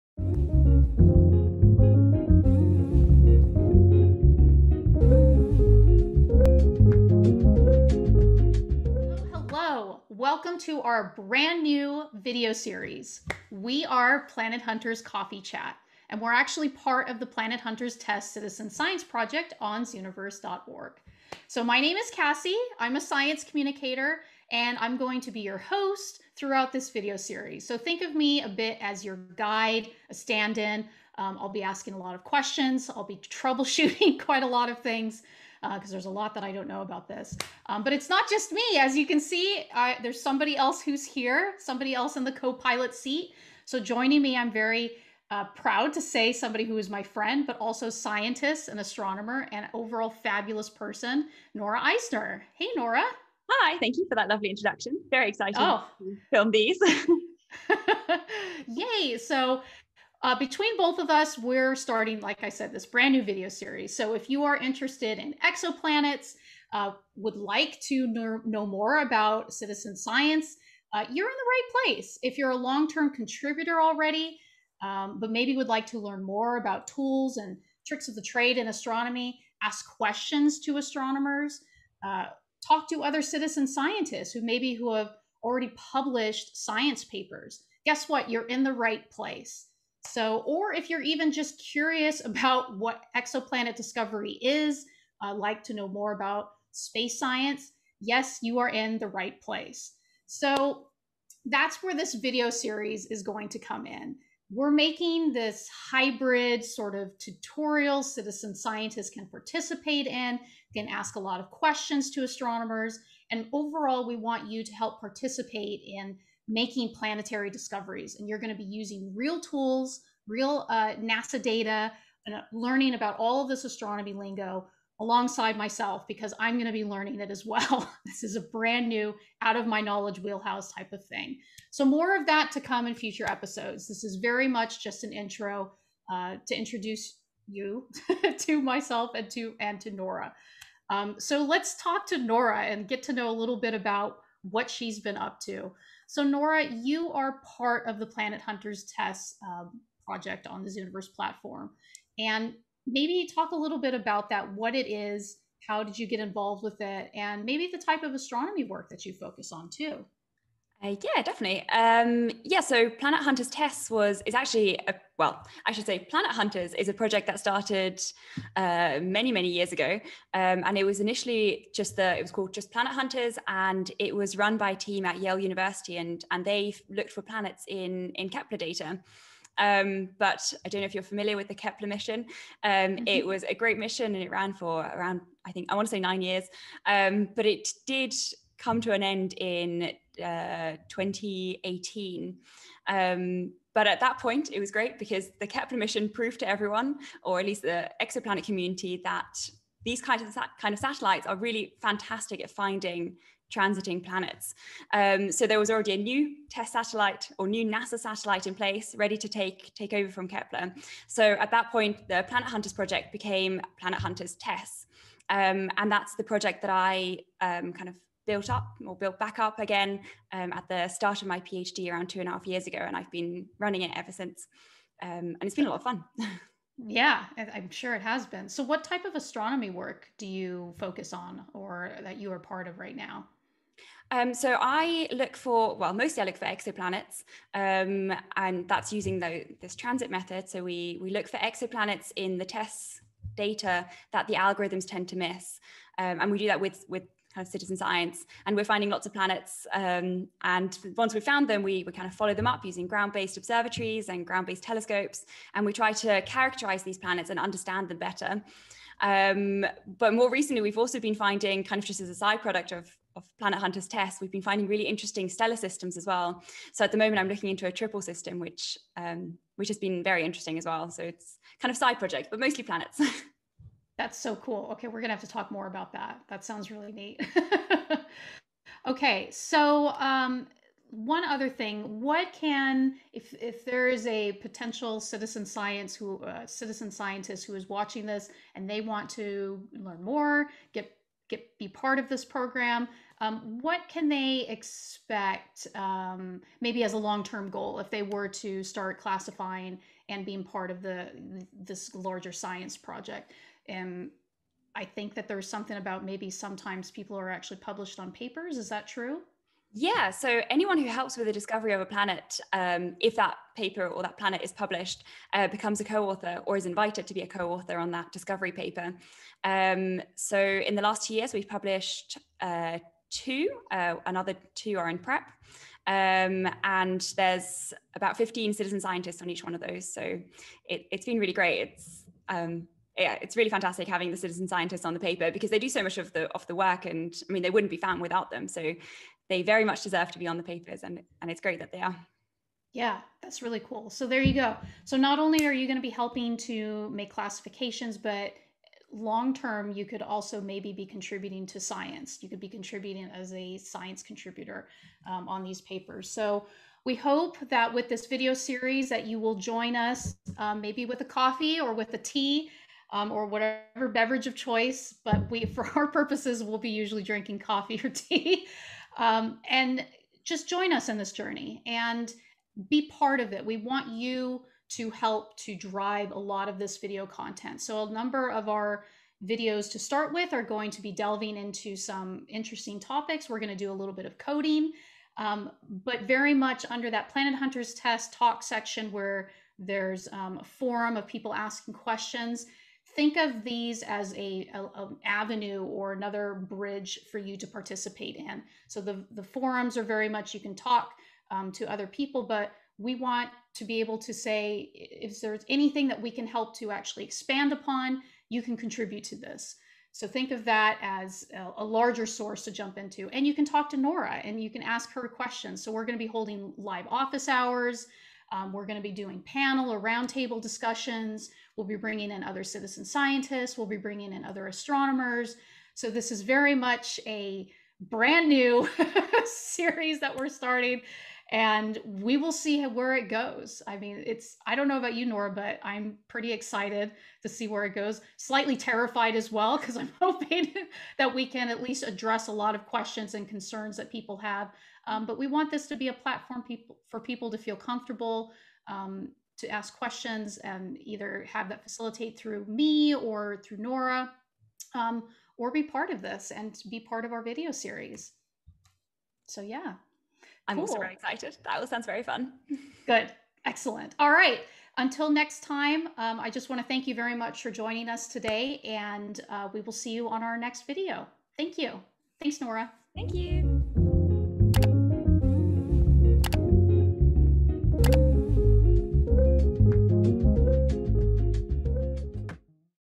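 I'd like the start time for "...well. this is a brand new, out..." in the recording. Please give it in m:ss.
2:07.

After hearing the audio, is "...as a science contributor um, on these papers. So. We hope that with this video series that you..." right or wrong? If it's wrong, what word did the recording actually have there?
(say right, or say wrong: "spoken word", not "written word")
right.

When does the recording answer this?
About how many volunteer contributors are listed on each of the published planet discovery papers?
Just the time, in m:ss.
5:27.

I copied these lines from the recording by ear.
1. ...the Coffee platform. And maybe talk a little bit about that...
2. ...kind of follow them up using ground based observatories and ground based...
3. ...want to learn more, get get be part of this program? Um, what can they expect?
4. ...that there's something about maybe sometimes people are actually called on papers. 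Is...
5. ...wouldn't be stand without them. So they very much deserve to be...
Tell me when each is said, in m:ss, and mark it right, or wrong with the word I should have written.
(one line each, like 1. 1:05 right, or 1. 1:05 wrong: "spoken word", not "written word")
1. 2:30 wrong: "Zooniverse", not "Coffee"
2. 4:11 right
3. 4:48 right
4. 5:05 wrong: "published", not "called"
5. 5:37 wrong: "found", not "stand".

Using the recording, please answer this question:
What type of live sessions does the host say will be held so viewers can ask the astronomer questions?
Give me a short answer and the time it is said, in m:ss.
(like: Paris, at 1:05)
office hours, at 6:56.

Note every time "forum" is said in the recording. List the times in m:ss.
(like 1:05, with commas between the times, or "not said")
6:30, 6:39.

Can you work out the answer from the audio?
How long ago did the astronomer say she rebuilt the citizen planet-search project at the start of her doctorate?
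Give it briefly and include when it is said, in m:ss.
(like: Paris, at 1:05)
two and a half years, at 3:41.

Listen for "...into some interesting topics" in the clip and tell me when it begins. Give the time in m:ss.
6:21.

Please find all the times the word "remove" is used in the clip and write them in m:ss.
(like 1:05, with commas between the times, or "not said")
not said.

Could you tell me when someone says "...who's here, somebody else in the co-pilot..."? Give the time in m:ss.
0:40.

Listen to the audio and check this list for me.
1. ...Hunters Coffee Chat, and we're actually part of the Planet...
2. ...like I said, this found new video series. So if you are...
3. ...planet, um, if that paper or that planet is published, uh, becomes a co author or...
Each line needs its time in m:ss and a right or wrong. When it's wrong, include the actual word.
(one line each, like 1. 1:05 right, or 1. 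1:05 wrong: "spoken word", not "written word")
1. 0:14 right
2. 1:02 wrong: "brand", not "found"
3. 5:11 right.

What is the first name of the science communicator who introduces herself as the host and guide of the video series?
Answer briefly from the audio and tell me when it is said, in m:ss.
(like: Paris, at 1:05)
Kassie, at 0:22.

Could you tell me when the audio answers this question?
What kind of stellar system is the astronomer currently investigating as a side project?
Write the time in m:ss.
4:27.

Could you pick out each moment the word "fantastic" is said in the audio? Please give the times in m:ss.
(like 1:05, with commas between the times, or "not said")
3:21, 5:33.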